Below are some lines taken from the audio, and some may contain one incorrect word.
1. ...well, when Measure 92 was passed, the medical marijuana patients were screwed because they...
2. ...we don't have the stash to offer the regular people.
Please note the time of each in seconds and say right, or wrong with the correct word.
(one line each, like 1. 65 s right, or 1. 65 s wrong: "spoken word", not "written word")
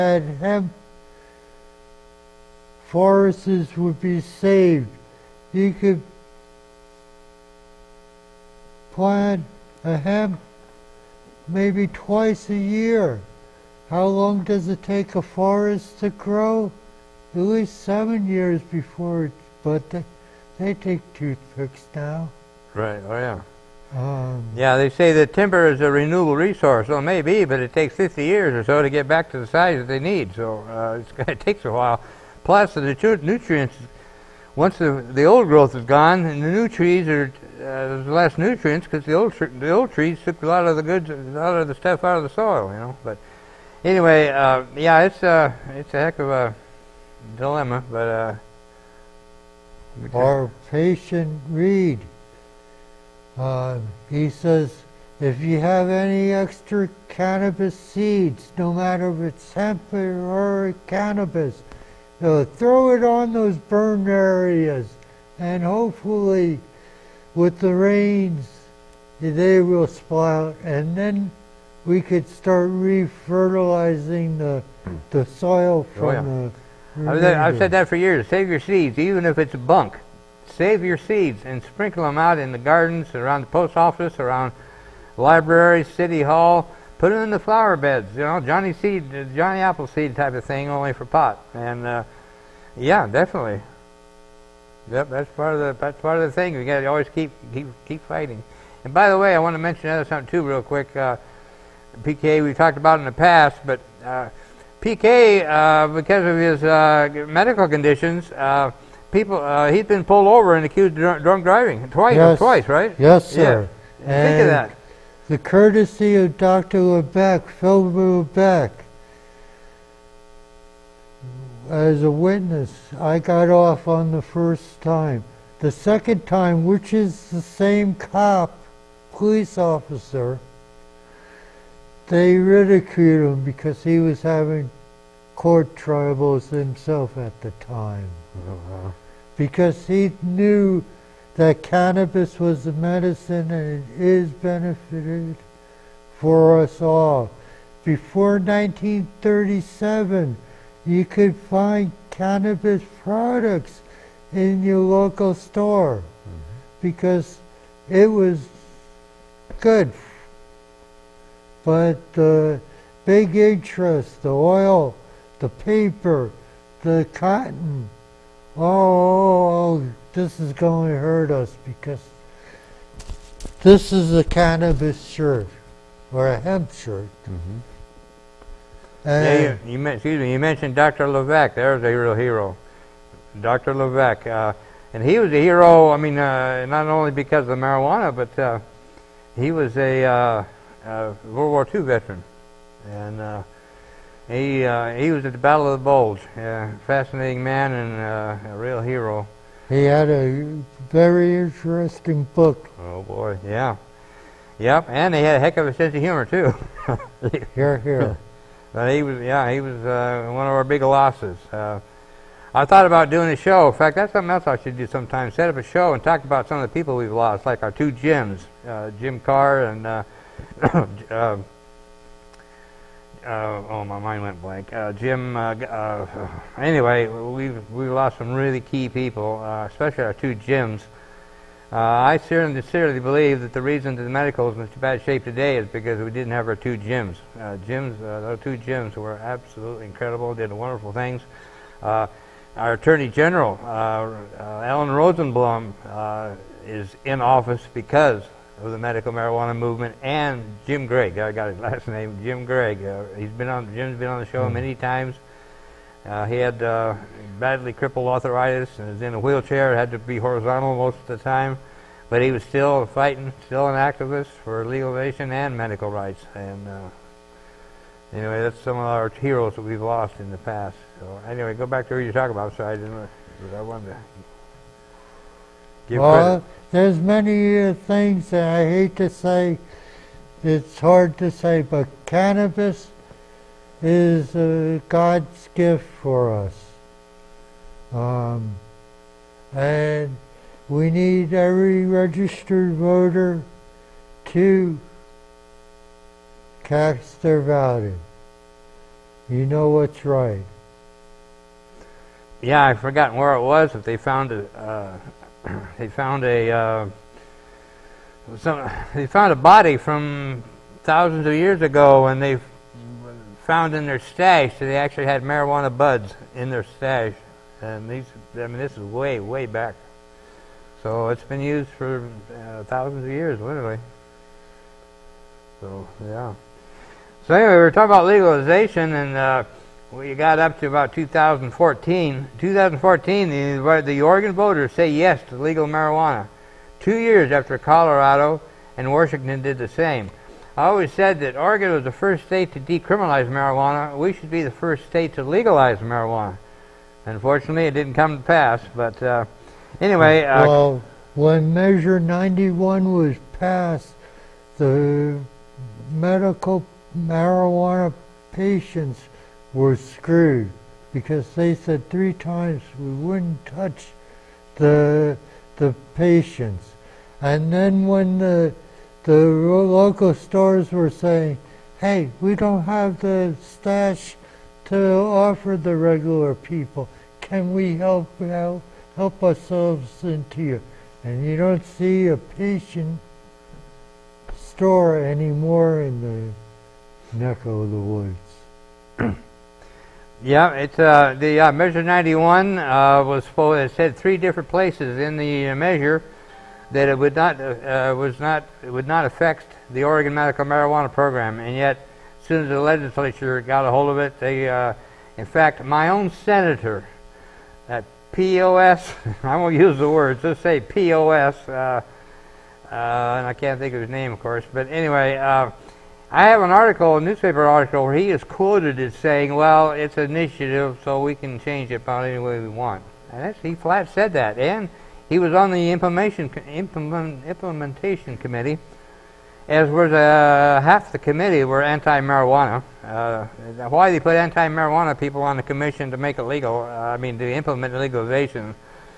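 1. 350 s wrong: "91", not "92"
2. 372 s right.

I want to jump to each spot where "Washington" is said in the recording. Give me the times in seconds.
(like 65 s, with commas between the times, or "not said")
338 s.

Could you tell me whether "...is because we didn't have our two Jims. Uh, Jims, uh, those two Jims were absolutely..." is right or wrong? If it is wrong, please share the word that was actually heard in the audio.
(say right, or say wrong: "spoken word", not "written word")
right.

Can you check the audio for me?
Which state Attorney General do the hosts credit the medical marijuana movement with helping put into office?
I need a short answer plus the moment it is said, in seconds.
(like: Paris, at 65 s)
Ellen Rosenblum, at 244 s.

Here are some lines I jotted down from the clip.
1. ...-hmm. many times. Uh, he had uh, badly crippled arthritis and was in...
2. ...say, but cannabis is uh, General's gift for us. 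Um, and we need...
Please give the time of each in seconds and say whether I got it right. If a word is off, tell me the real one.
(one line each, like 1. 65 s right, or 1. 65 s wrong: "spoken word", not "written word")
1. 254 s right
2. 281 s wrong: "God", not "General".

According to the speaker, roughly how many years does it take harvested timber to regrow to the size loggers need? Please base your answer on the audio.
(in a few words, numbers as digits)
50 years.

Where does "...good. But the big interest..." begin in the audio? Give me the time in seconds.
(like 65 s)
159 s.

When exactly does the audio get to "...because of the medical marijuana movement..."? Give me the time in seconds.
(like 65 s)
247 s.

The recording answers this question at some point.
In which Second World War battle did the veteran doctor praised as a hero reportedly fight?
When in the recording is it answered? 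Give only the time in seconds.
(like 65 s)
195 s.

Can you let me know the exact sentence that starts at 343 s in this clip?
We should be the first state to legalize marijuana.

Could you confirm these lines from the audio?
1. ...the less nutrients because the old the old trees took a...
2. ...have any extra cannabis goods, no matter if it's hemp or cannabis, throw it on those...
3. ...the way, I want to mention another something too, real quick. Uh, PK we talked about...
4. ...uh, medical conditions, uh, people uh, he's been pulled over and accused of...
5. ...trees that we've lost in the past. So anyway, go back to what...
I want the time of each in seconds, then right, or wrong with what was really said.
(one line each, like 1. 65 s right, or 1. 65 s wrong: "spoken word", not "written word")
1. 38 s right
2. 55 s wrong: "seeds", not "goods"
3. 99 s right
4. 106 s right
5. 269 s wrong: "heroes", not "trees".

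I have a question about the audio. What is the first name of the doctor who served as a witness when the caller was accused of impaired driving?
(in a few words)
Phil.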